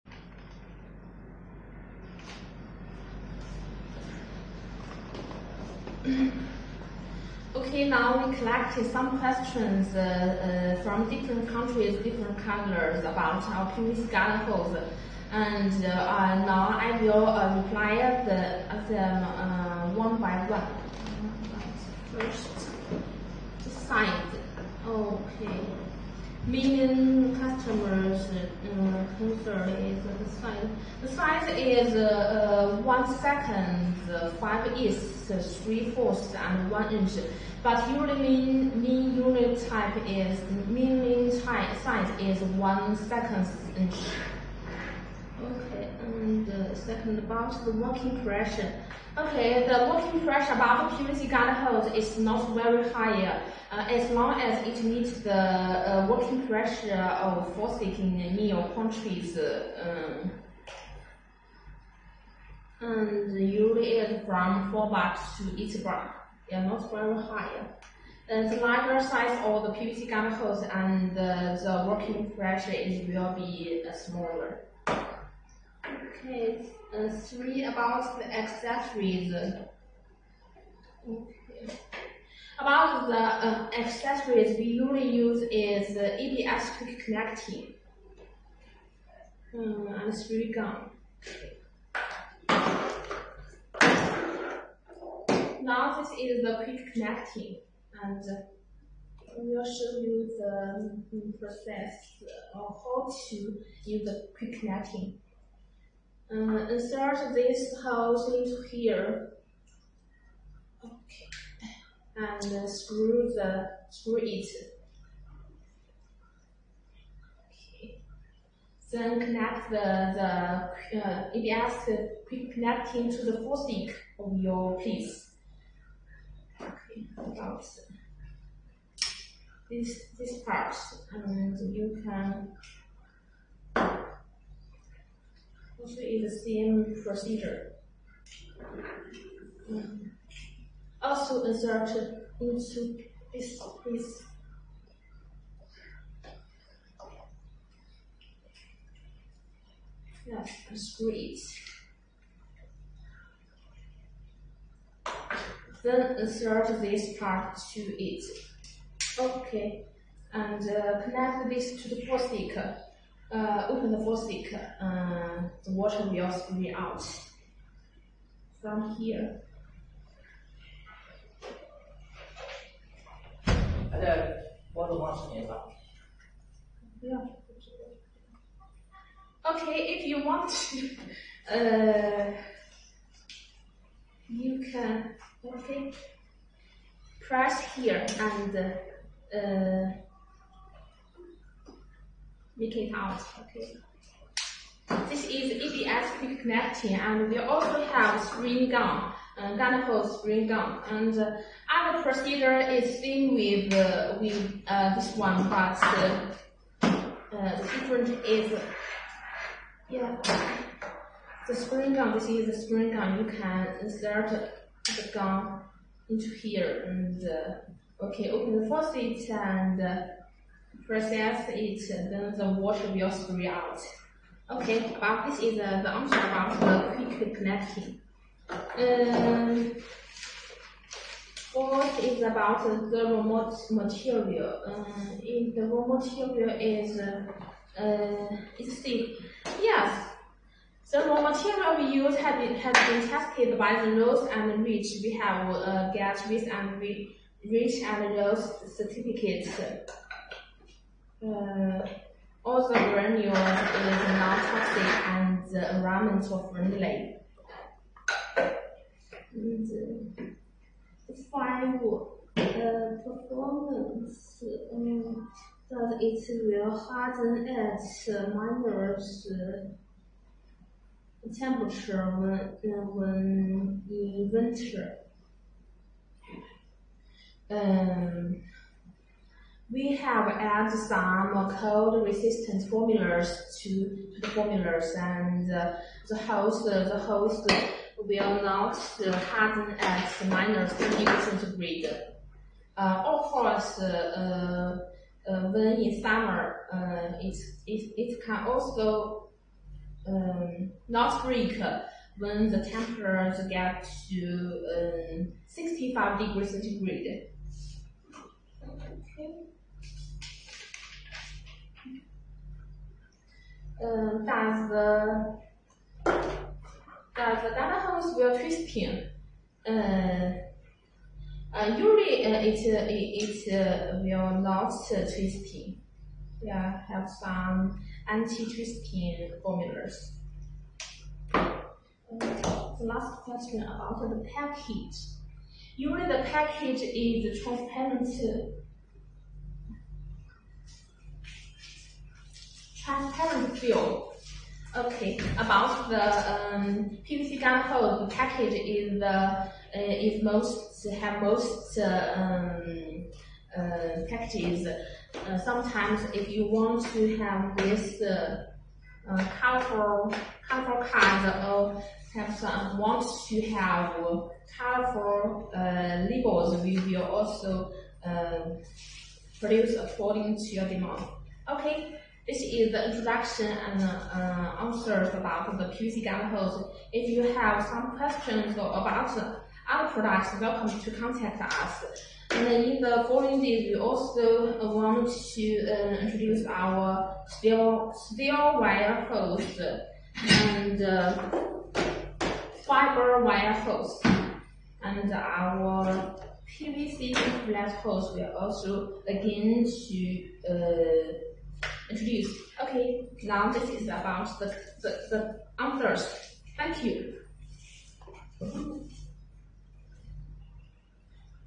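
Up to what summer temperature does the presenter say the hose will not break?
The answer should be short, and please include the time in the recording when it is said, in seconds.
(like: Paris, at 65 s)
65 °C, at 305 s.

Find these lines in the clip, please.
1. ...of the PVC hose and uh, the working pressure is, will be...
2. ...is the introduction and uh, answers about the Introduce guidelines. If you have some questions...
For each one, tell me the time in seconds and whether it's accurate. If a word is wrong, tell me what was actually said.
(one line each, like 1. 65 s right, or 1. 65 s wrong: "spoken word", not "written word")
1. 69 s right
2. 372 s wrong: "PVC", not "Introduce".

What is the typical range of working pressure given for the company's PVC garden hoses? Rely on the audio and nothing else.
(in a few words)
4 bar to 8 bar.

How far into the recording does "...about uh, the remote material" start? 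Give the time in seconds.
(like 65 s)
232 s.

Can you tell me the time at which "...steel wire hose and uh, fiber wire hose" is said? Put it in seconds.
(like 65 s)
387 s.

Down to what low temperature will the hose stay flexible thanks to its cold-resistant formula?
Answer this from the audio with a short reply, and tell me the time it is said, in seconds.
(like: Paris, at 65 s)
-20 °C, at 290 s.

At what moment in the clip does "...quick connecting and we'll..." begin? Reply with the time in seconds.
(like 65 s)
96 s.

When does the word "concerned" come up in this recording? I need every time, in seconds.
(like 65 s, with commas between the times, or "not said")
29 s.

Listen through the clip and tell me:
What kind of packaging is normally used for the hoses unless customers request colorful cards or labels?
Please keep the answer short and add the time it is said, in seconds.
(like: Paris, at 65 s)
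transparent film, at 342 s.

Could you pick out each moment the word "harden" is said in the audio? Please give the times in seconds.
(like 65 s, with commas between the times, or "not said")
266 s, 288 s.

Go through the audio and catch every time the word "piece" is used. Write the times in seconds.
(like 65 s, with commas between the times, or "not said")
124 s, 143 s.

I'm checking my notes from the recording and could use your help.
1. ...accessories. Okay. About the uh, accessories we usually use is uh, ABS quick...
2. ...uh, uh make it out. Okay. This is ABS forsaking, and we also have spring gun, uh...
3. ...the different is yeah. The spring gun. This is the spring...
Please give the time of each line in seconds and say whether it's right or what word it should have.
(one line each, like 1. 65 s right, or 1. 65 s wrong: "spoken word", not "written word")
1. 78 s right
2. 188 s wrong: "connecting", not "forsaking"
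3. 207 s right.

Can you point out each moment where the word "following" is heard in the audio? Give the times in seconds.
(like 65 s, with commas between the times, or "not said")
383 s.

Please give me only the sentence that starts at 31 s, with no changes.
The size is uh, uh, one second, five is three fourths, and one inch.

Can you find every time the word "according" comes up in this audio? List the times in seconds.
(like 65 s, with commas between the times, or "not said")
369 s.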